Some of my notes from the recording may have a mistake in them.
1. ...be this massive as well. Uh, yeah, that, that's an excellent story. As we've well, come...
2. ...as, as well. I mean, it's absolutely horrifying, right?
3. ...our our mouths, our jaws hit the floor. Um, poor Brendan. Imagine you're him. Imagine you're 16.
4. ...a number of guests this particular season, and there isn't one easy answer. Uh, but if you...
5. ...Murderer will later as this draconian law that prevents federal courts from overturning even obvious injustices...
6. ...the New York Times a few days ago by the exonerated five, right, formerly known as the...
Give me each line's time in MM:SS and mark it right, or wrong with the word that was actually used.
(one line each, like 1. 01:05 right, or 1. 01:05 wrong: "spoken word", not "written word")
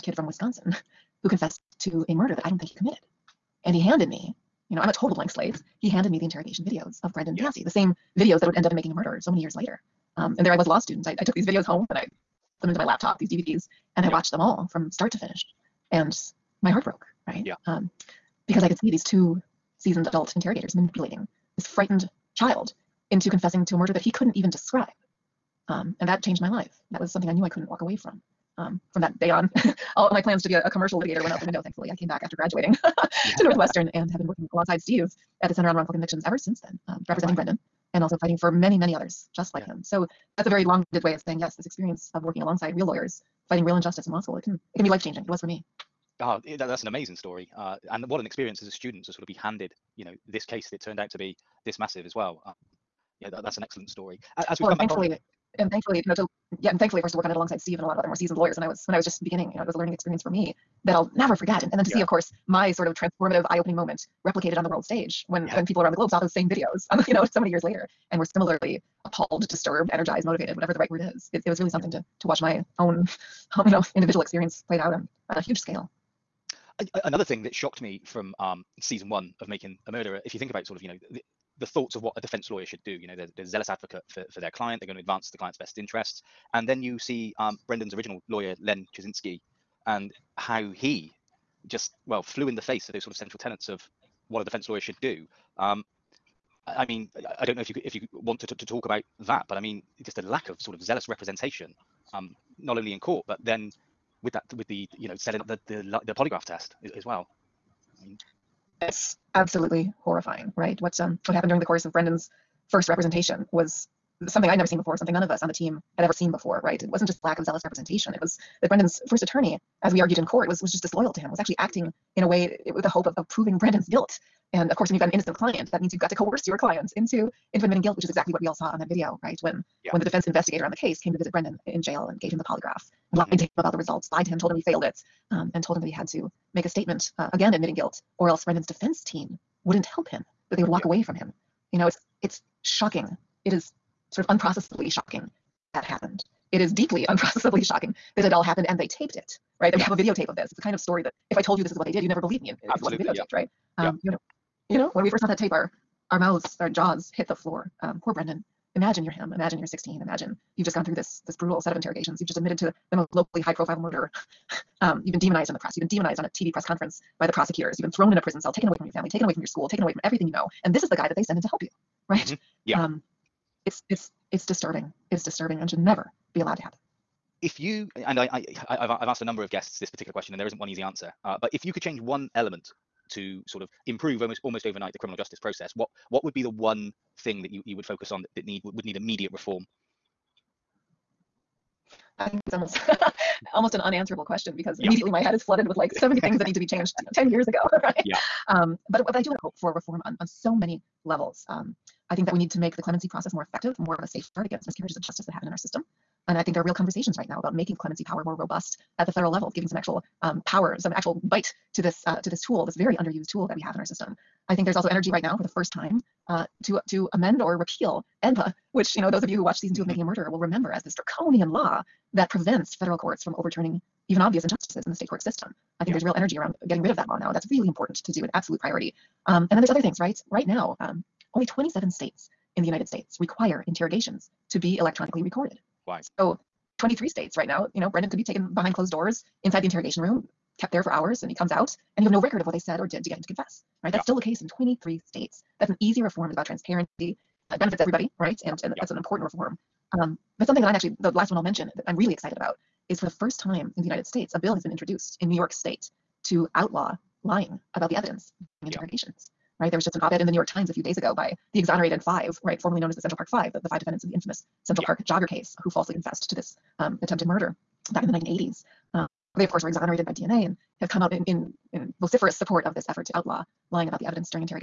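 1. 00:51 right
2. 01:46 right
3. 02:35 right
4. 02:59 wrong: "question", not "season"
5. 03:40 wrong: "remember", not "later"
6. 04:20 right.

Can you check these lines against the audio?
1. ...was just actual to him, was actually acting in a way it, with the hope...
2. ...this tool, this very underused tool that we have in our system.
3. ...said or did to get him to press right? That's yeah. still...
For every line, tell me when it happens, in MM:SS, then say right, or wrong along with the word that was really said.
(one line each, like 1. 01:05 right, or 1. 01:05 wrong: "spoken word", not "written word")
1. 02:00 wrong: "disloyal", not "actual"
2. 03:32 right
3. 04:02 wrong: "confess", not "press".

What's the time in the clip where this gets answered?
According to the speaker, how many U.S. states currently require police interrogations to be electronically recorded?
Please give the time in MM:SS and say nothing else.
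03:51.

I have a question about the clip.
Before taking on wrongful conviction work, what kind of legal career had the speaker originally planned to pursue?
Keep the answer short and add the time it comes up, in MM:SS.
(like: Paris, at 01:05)
commercial litigator, at 00:30.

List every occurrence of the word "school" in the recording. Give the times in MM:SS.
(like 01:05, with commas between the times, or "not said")
00:44, 02:49.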